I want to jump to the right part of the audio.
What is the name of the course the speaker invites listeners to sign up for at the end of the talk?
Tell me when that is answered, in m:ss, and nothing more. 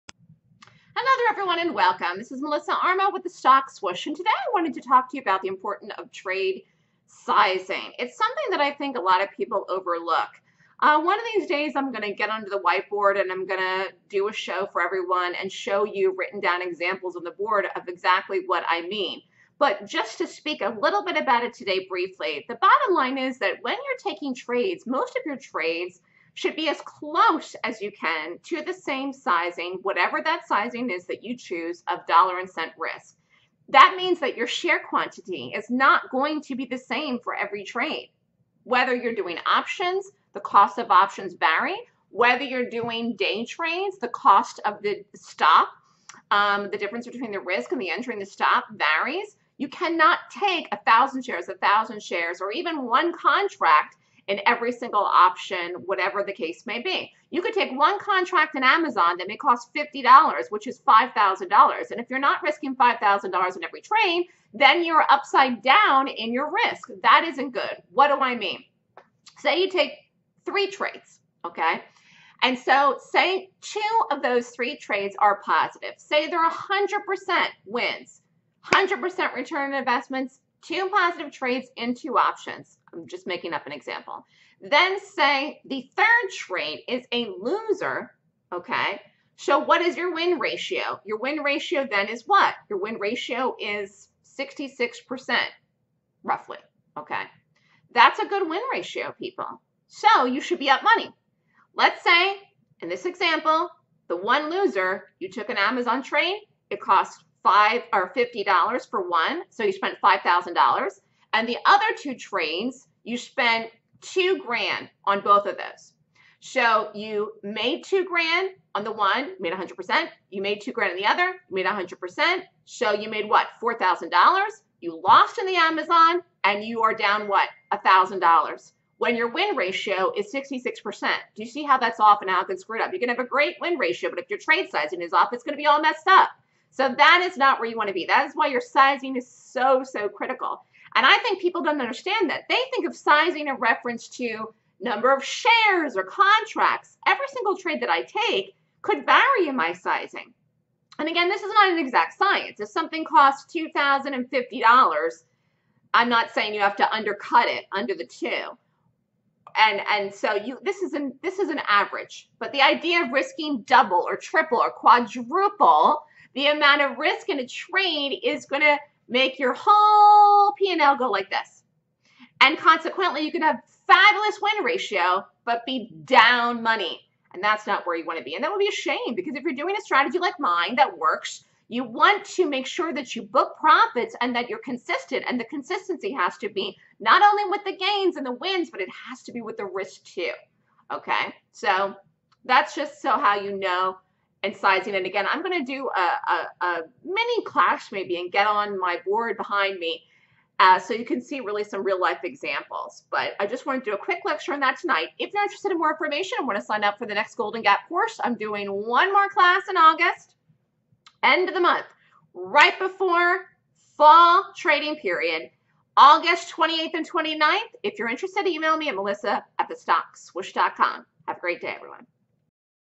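3:27.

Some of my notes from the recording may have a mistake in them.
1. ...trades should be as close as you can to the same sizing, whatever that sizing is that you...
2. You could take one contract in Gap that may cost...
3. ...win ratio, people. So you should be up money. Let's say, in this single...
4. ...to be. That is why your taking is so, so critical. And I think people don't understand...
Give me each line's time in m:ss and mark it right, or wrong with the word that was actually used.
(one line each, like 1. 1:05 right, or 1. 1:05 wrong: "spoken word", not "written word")
1. 0:25 right
2. 0:57 wrong: "Amazon", not "Gap"
3. 1:38 wrong: "example", not "single"
4. 2:17 wrong: "sizing", not "taking".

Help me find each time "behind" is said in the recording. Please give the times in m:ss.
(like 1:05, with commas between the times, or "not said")
3:19.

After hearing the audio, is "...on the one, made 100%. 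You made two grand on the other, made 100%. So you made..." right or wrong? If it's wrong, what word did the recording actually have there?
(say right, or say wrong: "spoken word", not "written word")
right.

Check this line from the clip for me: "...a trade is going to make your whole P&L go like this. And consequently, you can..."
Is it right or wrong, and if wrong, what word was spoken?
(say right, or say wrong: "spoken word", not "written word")
right.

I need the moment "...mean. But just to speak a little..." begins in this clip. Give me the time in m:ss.
0:18.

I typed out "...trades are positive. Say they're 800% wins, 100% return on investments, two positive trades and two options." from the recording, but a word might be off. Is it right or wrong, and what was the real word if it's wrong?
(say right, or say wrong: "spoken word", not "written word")
wrong: "100", not "800".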